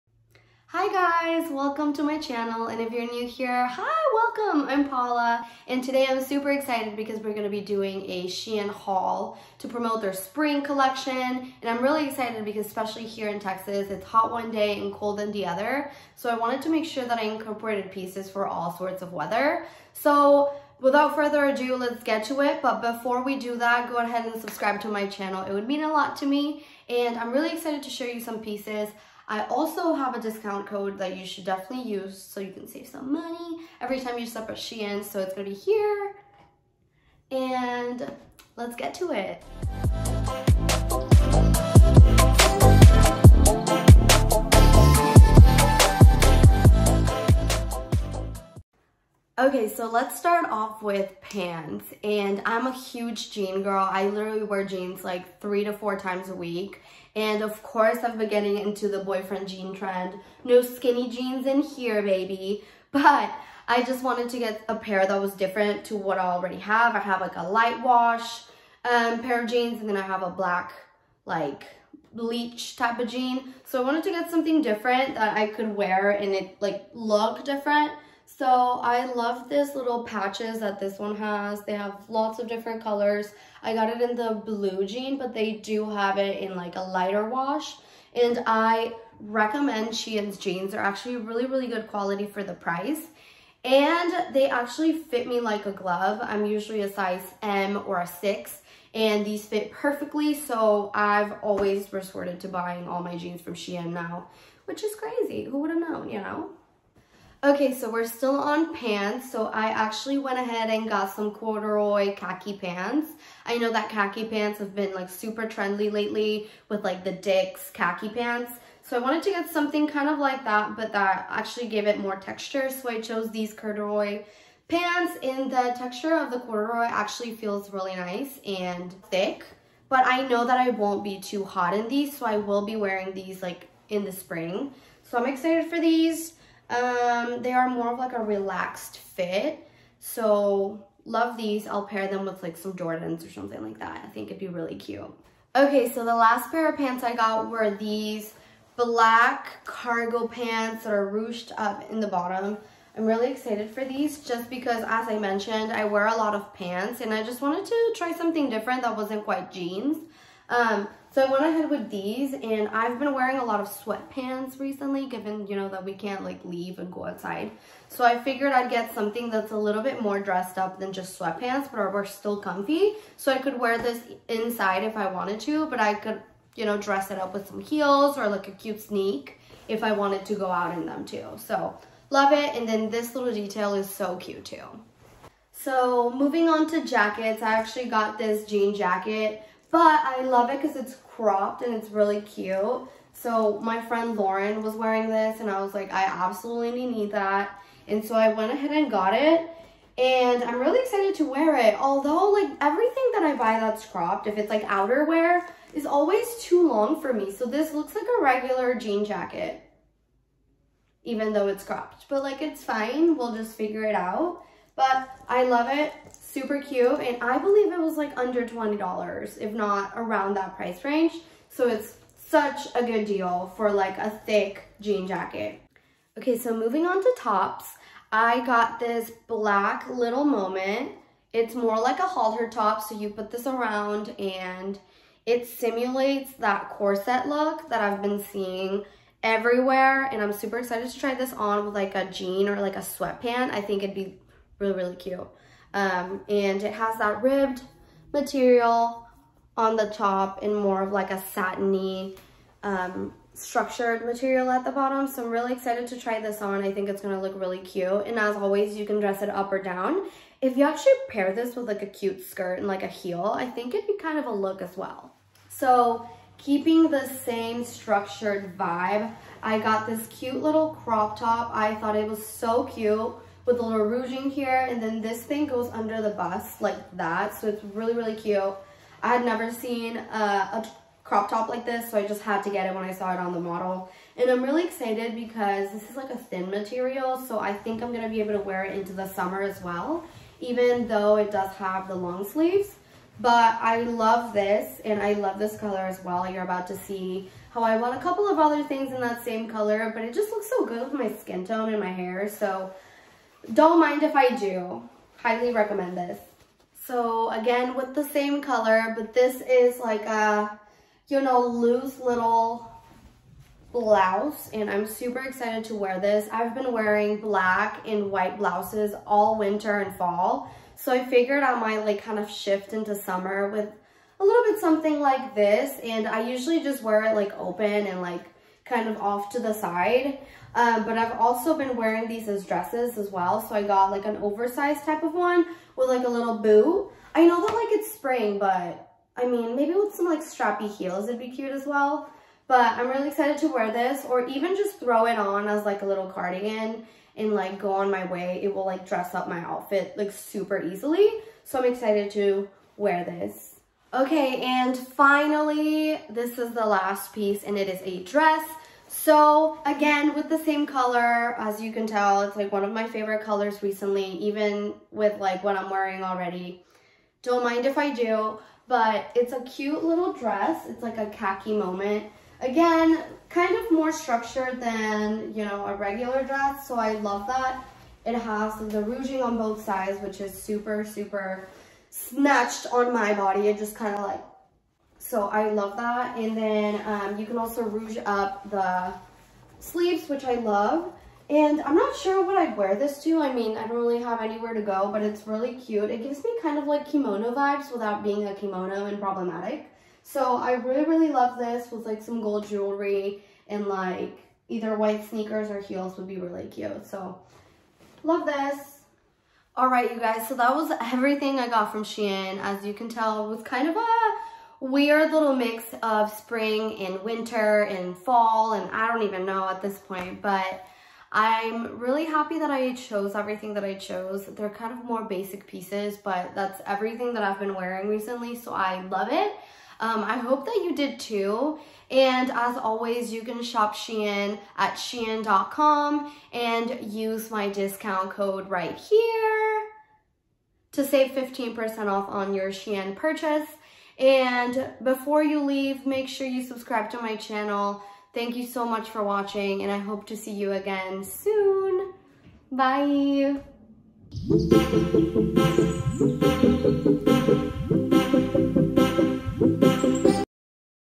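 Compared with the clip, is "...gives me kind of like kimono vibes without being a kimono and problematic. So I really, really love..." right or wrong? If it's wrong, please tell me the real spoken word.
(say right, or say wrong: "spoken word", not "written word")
right.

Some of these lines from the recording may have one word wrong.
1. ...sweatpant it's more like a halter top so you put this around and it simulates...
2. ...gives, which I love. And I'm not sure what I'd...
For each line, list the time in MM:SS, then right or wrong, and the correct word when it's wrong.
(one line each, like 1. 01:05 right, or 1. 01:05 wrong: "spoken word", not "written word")
1. 03:50 wrong: "moment", not "sweatpant"
2. 06:29 wrong: "sleeves", not "gives".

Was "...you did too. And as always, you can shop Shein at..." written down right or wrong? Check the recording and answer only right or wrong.
right.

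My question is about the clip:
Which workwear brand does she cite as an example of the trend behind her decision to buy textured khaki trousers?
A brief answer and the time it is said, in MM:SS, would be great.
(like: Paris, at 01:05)
Dickies, at 01:57.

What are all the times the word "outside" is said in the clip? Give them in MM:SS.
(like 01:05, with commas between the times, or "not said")
02:47.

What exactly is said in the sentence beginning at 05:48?
It will like dress up my outfit like super easily.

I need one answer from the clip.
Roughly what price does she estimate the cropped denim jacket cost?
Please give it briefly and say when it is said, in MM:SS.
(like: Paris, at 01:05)
under $20, at 03:38.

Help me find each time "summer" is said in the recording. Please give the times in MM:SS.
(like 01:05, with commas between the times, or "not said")
04:49, 05:22.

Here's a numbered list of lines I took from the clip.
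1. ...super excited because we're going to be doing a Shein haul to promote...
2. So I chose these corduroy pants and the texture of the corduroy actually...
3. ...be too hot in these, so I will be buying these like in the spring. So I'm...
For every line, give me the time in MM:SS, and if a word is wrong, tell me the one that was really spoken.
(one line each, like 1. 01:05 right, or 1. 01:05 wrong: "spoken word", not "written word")
1. 00:06 right
2. 02:02 right
3. 02:11 wrong: "wearing", not "buying".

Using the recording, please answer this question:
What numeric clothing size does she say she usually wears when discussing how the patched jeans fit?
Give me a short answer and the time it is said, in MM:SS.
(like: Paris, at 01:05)
6, at 01:38.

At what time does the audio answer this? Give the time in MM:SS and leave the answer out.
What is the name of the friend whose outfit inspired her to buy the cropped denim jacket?
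03:14.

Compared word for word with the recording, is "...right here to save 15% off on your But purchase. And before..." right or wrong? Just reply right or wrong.
wrong.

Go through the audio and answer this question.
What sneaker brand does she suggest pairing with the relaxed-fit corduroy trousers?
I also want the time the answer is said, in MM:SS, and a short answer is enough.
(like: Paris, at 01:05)
Jordans, at 02:22.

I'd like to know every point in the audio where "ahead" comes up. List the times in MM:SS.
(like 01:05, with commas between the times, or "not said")
00:23, 01:50, 02:41, 03:18.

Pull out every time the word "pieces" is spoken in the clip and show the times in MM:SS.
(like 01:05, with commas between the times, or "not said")
00:17, 00:28, 05:57, 07:05.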